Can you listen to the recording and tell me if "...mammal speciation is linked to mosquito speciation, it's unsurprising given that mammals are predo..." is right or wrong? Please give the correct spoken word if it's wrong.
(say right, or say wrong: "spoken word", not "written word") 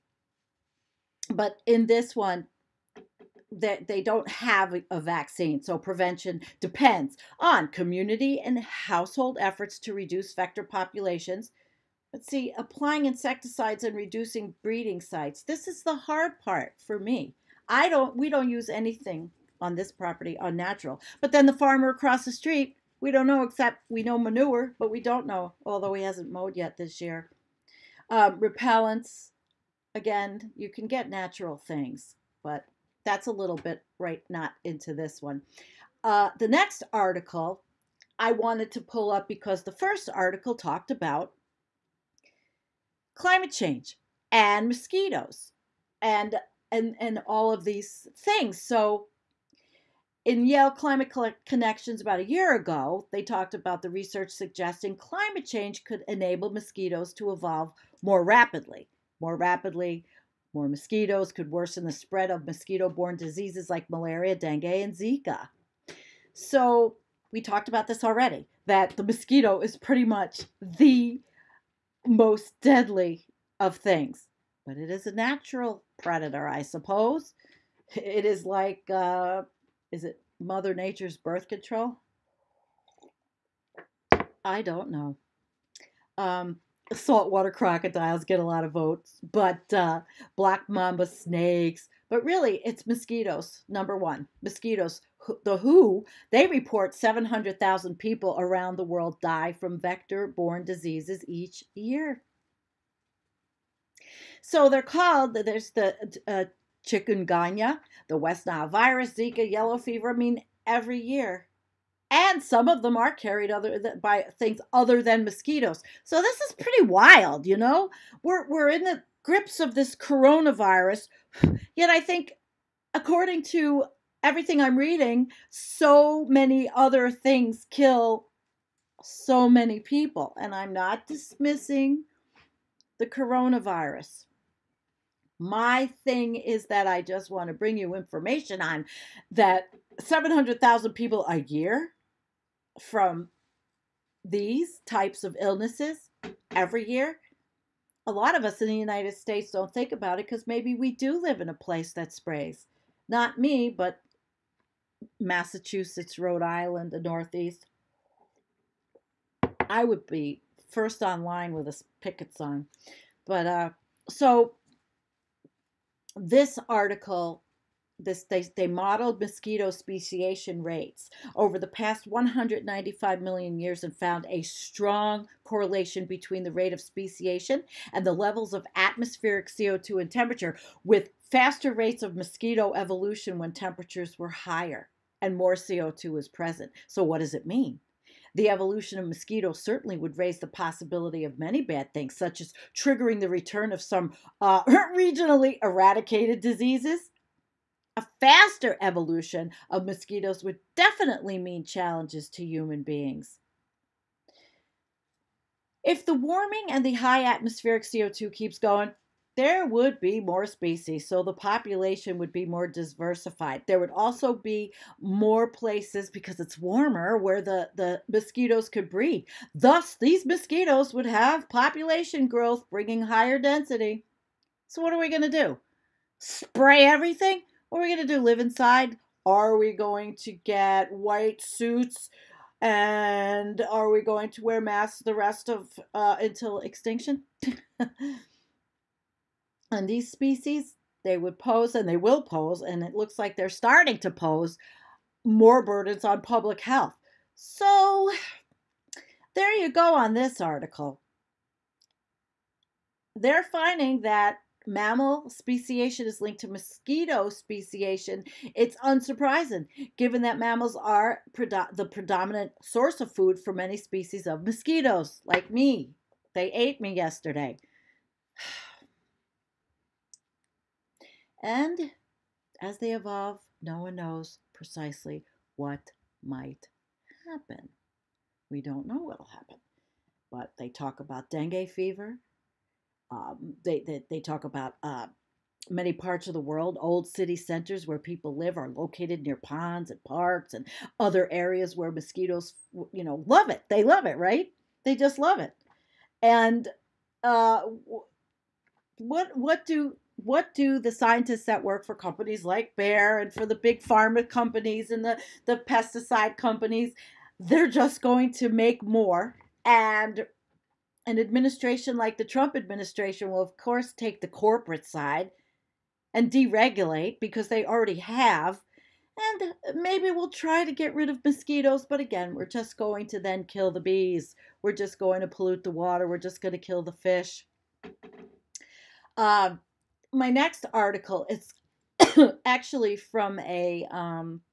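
right.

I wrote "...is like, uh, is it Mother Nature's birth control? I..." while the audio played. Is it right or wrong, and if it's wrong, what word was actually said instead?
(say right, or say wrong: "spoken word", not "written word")
right.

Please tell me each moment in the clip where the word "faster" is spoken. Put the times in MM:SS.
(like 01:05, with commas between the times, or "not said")
03:01, 03:18.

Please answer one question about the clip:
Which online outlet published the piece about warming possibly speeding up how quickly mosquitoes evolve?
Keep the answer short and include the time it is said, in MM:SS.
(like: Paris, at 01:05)
Yale Climate Connections, at 00:50.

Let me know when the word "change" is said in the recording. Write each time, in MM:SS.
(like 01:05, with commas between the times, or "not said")
00:43, 00:55.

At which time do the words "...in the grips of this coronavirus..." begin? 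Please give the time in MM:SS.
01:58.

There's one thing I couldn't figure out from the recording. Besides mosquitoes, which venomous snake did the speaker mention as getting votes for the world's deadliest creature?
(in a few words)
Black mamba.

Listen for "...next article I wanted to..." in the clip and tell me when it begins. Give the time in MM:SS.
00:36.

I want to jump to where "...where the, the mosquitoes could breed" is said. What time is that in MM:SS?
03:37.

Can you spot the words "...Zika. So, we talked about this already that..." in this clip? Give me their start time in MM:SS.
01:04.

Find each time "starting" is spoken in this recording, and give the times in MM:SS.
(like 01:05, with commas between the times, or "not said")
04:03.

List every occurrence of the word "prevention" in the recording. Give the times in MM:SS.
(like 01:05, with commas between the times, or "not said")
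00:05.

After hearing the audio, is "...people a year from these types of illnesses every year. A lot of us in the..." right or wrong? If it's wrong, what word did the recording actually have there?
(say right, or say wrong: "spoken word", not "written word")
right.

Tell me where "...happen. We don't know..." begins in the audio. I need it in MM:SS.
04:37.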